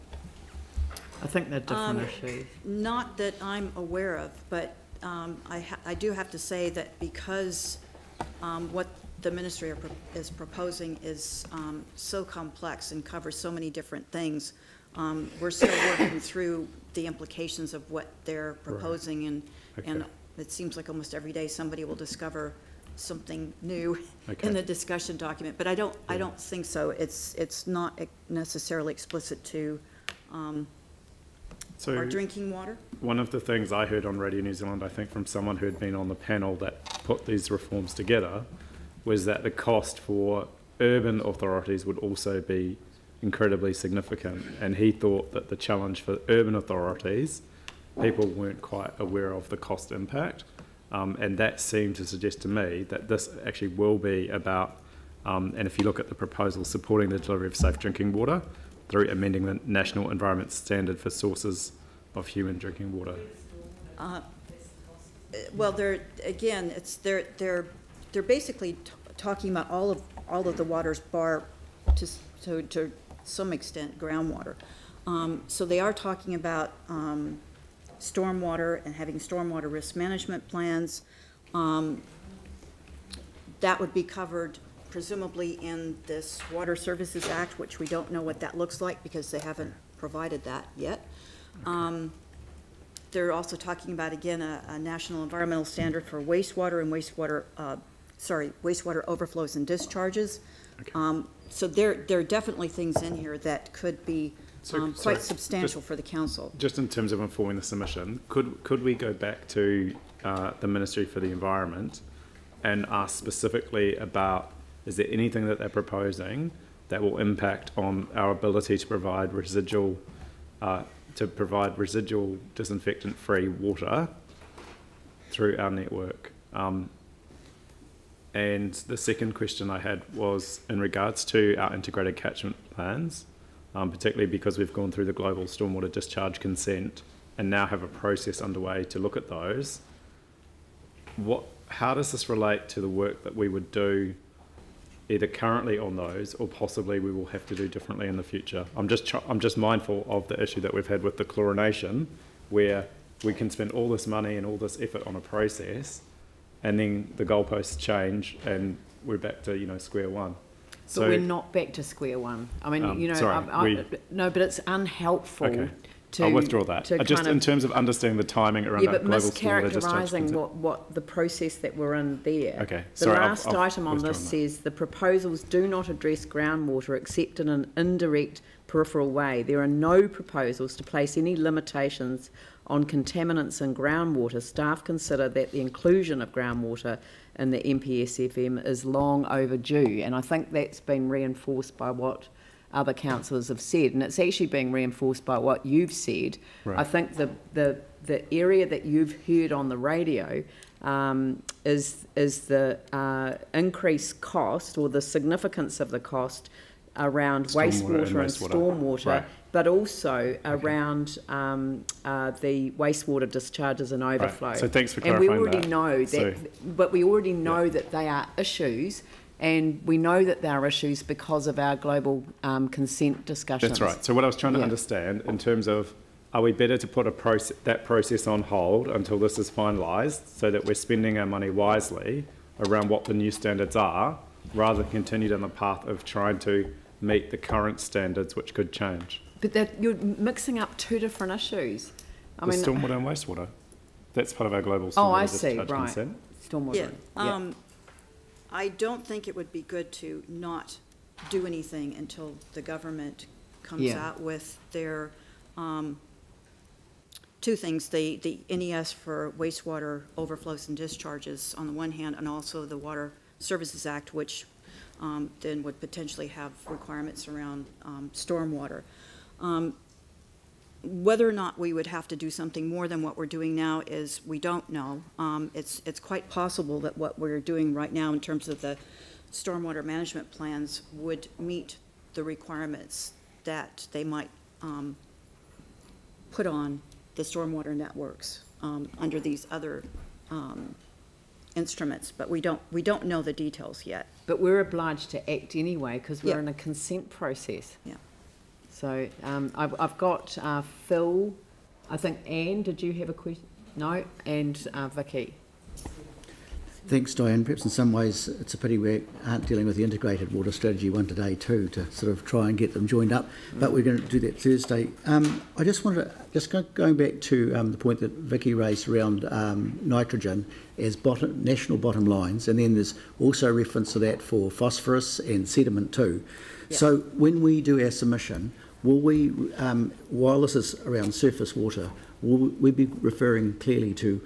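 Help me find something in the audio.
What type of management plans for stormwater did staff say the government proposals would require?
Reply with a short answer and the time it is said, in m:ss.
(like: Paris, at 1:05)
risk management plans, at 1:19.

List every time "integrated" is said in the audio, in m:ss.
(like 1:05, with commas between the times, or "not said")
2:11, 5:09.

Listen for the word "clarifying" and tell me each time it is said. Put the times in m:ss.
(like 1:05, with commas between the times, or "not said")
3:35.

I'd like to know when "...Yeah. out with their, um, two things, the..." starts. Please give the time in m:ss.
4:13.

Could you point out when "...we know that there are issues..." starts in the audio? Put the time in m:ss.
3:39.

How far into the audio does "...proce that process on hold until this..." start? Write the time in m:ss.
3:47.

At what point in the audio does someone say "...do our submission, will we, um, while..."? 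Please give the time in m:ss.
5:27.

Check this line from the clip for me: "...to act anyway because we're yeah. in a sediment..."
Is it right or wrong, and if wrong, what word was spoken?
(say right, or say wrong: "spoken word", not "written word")
wrong: "consent", not "sediment".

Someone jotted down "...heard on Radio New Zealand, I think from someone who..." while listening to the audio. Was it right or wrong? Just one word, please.
right.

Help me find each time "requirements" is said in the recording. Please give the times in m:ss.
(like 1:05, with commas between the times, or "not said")
4:26, 4:42.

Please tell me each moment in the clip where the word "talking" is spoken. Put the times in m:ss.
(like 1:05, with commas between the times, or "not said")
1:09, 1:15, 1:33.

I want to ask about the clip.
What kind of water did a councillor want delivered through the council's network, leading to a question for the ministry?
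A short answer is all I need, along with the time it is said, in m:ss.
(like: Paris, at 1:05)
residual disinfectant-free water, at 2:01.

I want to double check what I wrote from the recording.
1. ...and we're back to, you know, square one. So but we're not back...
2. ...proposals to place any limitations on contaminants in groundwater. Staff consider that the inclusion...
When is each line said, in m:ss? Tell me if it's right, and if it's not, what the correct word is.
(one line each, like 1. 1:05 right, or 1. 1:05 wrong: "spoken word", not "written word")
1. 2:38 right
2. 3:00 right.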